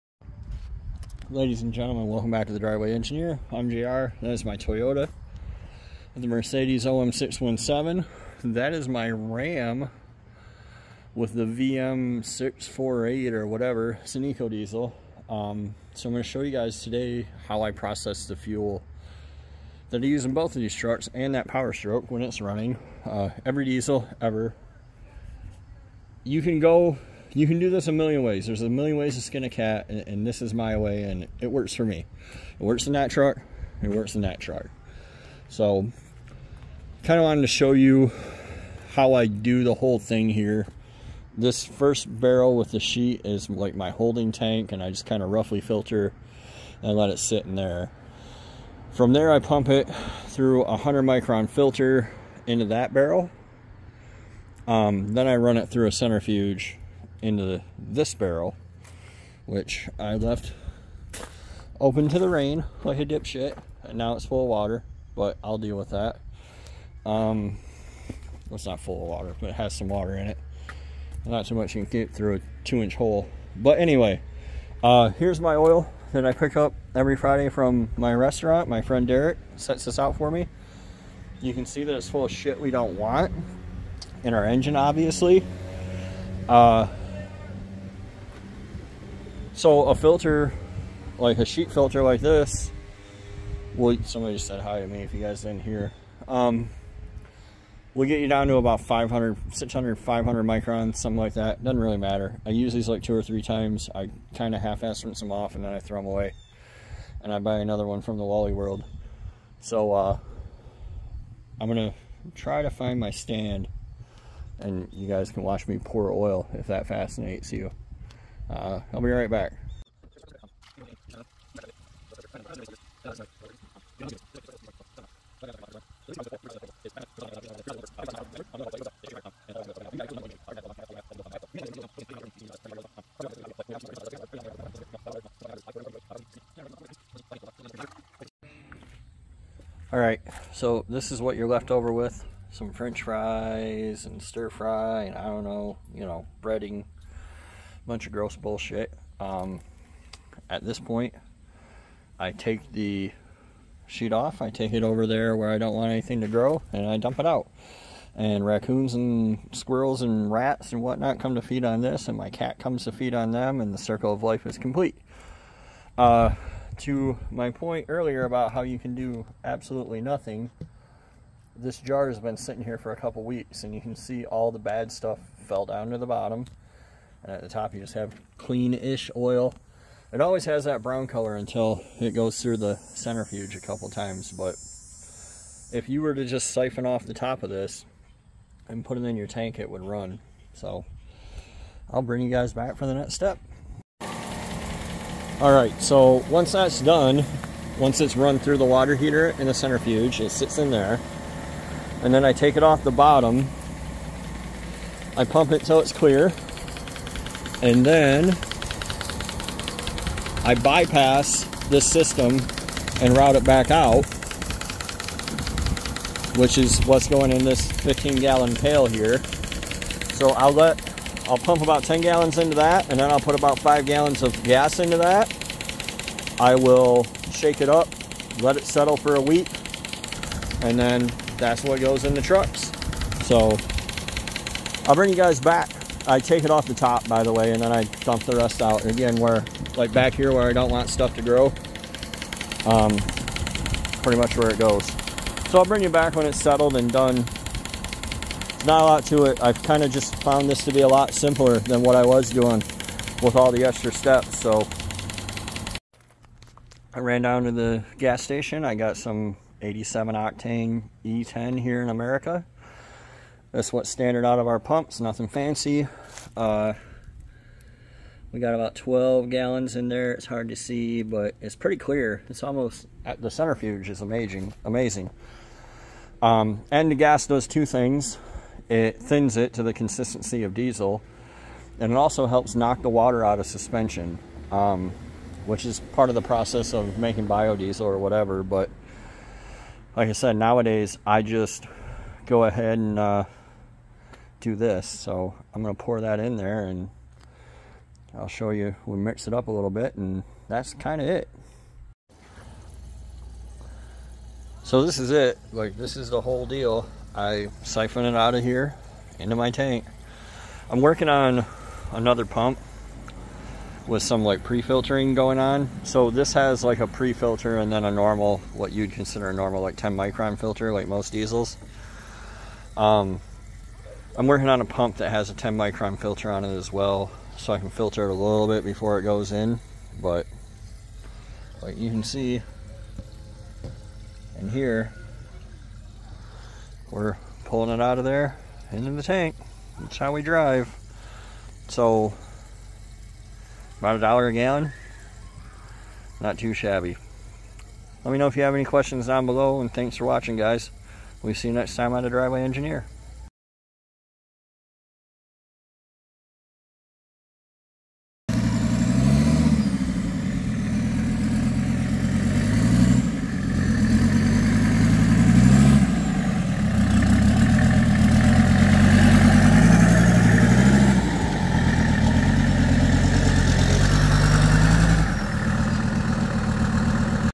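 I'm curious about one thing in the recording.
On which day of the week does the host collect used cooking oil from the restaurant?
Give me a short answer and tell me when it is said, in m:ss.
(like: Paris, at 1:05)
Friday, at 1:17.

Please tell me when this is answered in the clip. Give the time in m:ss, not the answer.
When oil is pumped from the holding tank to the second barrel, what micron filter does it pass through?
0:50.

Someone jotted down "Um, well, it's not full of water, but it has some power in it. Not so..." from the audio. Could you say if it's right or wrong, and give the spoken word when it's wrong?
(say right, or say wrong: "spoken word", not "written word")
wrong: "water", not "power".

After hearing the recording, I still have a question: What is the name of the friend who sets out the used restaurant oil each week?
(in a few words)
Derek.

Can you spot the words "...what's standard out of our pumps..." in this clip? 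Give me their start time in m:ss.
4:23.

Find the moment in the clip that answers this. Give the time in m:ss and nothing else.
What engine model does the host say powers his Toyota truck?
0:06.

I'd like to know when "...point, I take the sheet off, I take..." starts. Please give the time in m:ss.
2:30.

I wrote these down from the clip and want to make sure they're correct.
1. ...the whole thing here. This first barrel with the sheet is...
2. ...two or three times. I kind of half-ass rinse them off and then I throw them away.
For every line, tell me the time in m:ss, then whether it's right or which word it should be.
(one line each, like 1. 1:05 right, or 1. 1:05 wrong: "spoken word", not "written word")
1. 0:39 right
2. 1:43 right.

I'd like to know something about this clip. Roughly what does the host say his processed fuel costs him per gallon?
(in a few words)
about a dollar.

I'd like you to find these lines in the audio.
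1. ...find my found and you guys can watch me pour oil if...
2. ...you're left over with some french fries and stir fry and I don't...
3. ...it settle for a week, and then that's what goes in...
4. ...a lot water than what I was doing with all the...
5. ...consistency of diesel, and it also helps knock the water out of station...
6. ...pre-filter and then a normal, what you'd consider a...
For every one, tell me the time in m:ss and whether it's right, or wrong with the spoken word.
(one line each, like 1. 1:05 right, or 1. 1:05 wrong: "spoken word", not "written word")
1. 1:52 wrong: "stand", not "found"
2. 2:21 right
3. 3:48 right
4. 4:10 wrong: "simpler", not "water"
5. 4:39 wrong: "suspension", not "station"
6. 5:16 right.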